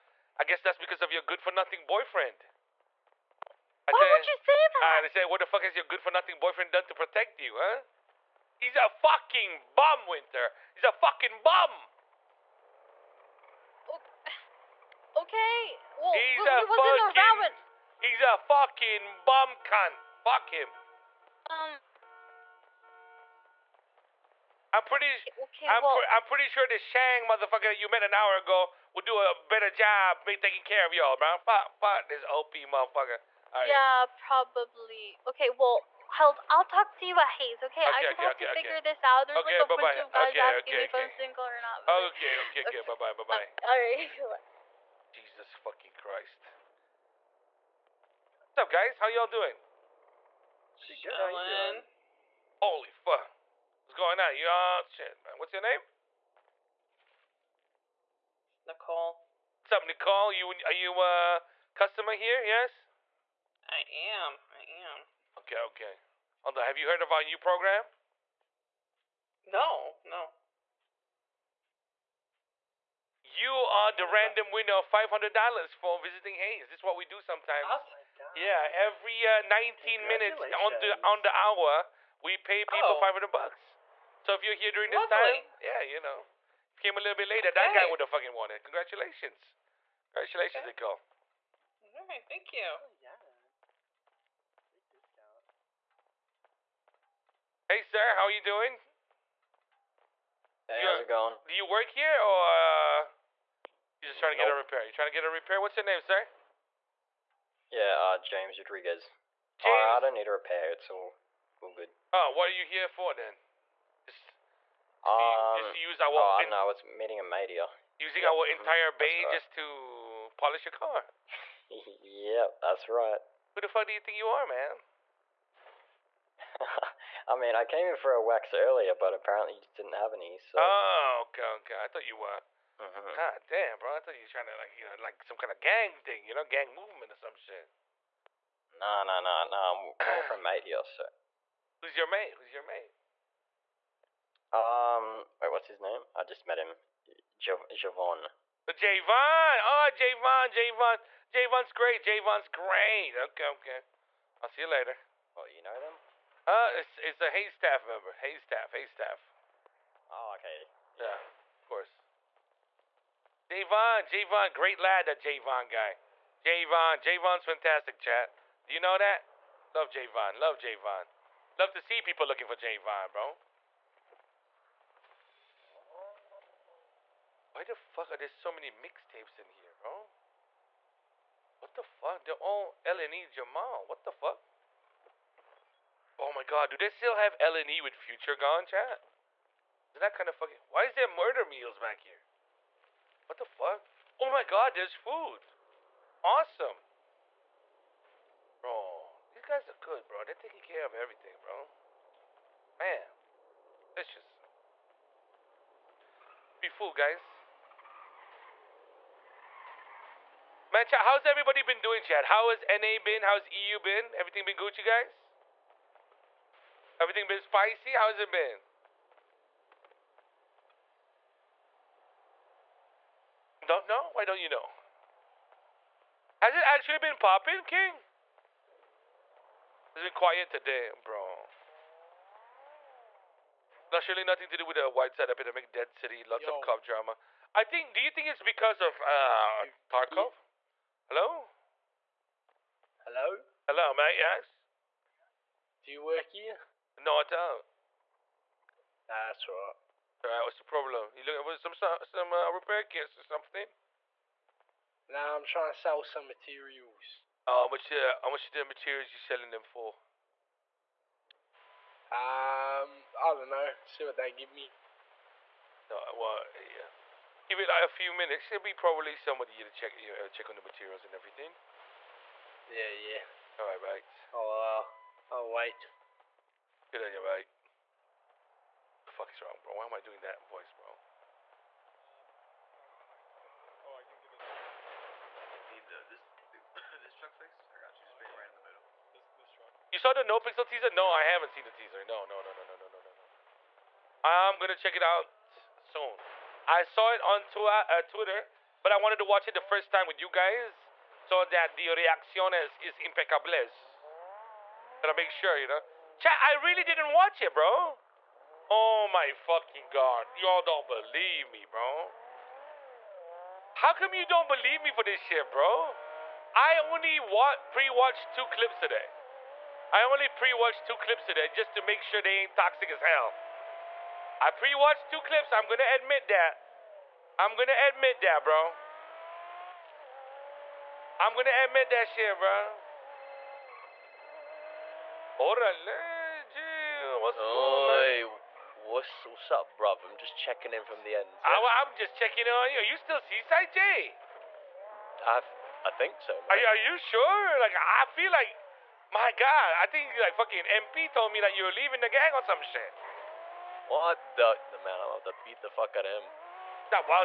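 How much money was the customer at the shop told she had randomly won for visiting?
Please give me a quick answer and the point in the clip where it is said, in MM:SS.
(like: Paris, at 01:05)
$500, at 01:14.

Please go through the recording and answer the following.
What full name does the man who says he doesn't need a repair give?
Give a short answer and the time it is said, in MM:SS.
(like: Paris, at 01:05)
James Rodriguez, at 01:48.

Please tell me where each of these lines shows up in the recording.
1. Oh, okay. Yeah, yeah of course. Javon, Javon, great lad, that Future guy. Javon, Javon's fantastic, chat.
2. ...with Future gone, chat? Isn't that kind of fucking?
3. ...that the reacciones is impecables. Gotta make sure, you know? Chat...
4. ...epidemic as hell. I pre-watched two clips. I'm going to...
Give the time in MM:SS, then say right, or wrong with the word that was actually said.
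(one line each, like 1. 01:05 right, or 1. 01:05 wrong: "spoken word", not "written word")
1. 02:40 wrong: "Javon", not "Future"
2. 03:07 right
3. 05:01 right
4. 05:22 wrong: "toxic", not "epidemic".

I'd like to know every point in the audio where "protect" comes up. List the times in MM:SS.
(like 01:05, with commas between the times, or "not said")
00:06.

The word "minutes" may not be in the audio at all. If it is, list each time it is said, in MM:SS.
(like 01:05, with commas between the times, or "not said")
01:20, 04:28.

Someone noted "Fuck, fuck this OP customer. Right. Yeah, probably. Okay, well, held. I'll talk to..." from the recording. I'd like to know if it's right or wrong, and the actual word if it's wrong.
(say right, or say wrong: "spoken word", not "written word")
wrong: "motherfucker", not "customer".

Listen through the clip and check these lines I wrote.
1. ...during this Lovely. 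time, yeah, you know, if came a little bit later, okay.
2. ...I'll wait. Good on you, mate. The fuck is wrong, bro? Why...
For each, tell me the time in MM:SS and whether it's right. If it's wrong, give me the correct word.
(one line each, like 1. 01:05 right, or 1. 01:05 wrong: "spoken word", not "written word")
1. 01:24 right
2. 04:35 right.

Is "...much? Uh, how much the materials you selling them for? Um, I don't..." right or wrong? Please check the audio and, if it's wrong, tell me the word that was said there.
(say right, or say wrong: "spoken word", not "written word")
right.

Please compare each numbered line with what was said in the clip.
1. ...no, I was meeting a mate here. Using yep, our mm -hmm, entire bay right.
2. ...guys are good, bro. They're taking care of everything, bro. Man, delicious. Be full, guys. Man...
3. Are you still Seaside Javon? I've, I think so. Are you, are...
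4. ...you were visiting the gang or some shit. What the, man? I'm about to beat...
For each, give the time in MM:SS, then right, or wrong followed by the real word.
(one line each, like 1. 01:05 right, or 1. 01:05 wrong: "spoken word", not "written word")
1. 01:56 right
2. 03:19 right
3. 05:42 wrong: "Jay", not "Javon"
4. 05:51 wrong: "leaving", not "visiting".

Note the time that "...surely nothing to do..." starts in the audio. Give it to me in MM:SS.
03:54.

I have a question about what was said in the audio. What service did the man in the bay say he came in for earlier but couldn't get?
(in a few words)
A wax.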